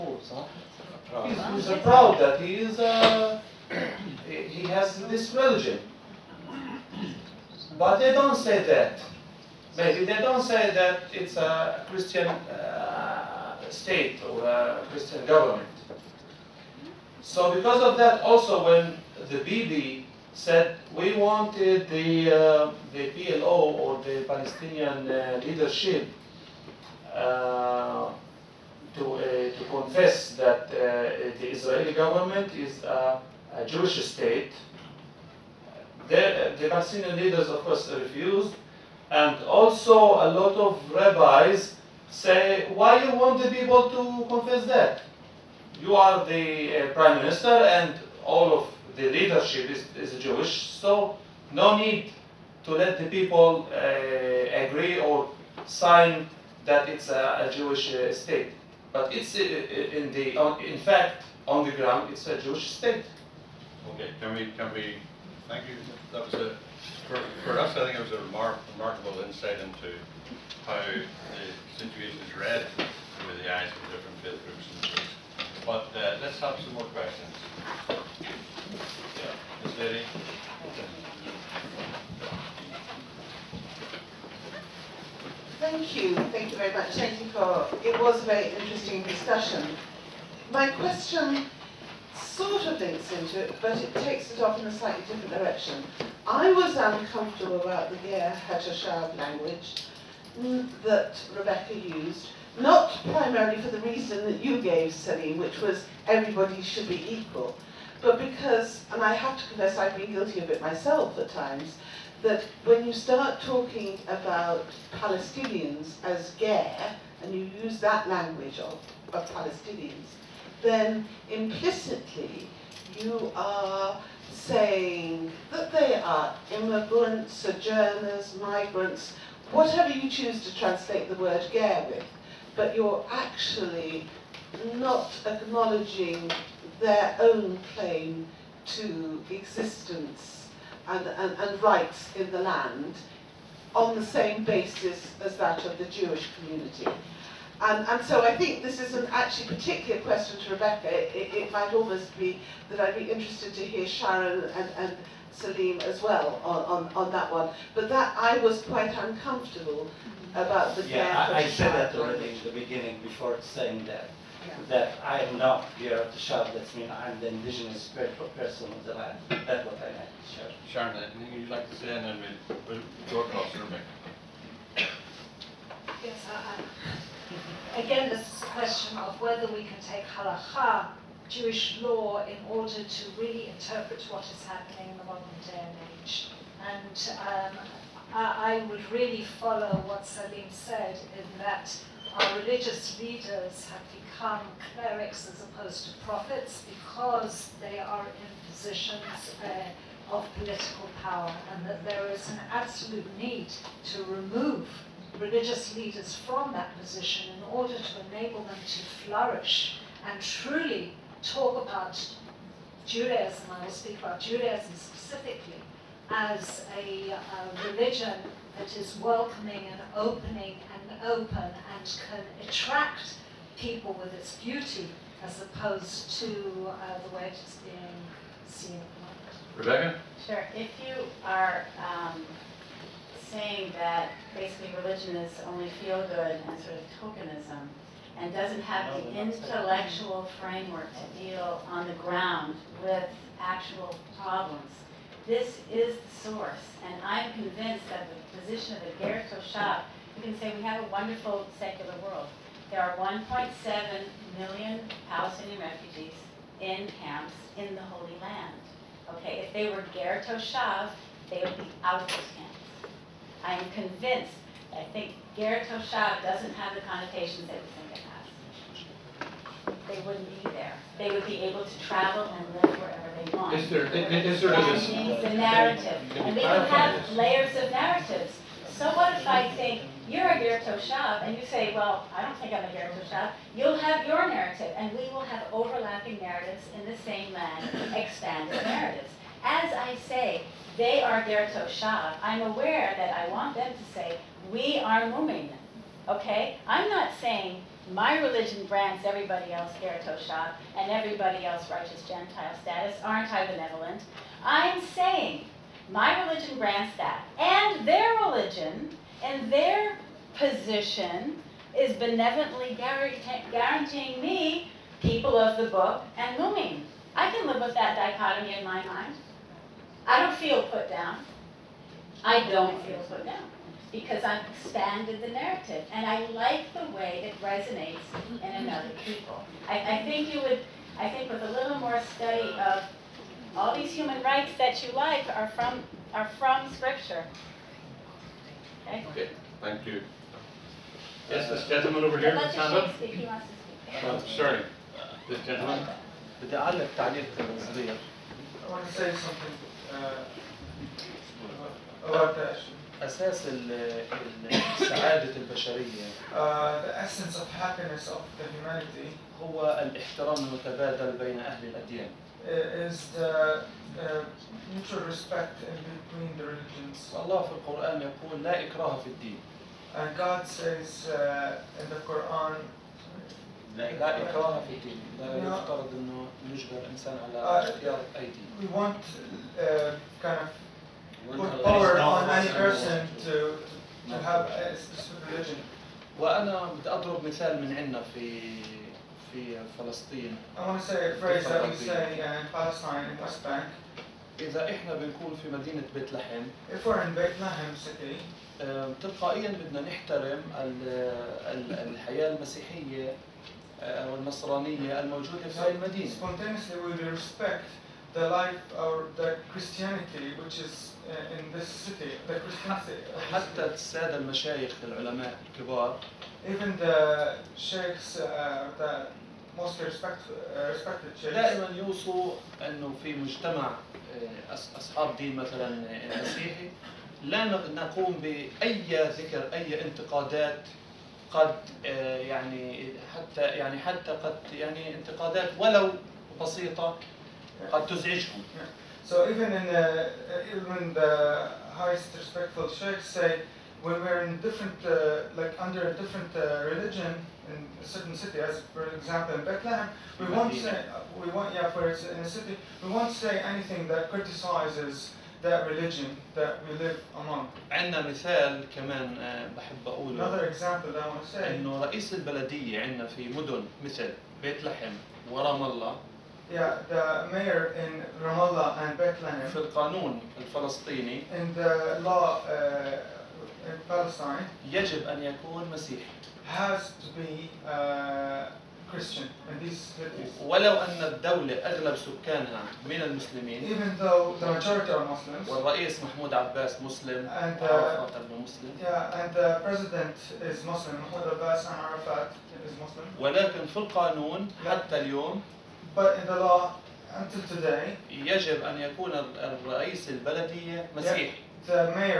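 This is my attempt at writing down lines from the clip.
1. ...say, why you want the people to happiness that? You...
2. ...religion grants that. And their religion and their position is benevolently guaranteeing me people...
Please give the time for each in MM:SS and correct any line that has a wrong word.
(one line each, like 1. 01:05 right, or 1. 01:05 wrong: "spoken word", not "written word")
1. 00:42 wrong: "confess", not "happiness"
2. 05:06 right.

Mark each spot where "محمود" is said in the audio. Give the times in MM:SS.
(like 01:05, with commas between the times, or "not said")
08:06, 08:11.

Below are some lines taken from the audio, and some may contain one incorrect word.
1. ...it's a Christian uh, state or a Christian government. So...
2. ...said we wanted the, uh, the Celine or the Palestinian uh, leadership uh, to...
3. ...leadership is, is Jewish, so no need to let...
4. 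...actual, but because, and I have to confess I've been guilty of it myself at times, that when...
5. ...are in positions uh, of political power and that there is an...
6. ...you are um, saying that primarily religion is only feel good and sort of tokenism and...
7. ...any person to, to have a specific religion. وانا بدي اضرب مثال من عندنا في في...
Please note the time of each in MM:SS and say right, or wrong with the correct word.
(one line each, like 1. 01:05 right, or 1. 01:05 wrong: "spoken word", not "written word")
1. 00:11 right
2. 00:20 wrong: "PLO", not "Celine"
3. 00:49 right
4. 01:47 wrong: "equal", not "actual"
5. 03:17 right
6. 03:50 wrong: "basically", not "primarily"
7. 06:22 right.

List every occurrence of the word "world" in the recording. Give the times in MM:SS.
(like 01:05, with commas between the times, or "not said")
04:12.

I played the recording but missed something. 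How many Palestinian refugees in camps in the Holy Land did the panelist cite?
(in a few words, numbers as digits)
1.7 million.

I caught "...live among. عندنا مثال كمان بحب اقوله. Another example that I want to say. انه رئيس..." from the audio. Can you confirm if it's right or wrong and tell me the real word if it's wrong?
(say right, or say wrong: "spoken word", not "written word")
right.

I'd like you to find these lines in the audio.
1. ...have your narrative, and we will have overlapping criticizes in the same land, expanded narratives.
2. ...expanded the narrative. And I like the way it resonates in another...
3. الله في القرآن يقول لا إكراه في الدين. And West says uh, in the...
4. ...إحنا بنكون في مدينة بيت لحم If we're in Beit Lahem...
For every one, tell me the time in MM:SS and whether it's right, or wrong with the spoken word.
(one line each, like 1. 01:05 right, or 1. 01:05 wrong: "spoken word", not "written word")
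1. 04:43 wrong: "narratives", not "criticizes"
2. 05:24 right
3. 06:07 wrong: "God", not "West"
4. 06:34 right.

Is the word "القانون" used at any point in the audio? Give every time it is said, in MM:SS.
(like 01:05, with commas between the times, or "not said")
07:49, 08:13.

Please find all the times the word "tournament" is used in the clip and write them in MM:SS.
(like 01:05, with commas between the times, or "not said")
not said.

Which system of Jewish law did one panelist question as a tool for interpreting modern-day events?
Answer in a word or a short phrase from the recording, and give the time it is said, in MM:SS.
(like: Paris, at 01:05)
halacha, at 03:00.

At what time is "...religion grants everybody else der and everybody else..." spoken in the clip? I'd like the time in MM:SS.
04:58.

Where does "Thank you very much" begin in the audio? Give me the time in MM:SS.
01:26.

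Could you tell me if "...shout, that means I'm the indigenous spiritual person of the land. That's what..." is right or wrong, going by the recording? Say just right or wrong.
right.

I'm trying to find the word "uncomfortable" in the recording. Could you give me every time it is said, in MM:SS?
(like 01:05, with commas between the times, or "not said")
01:36, 02:38.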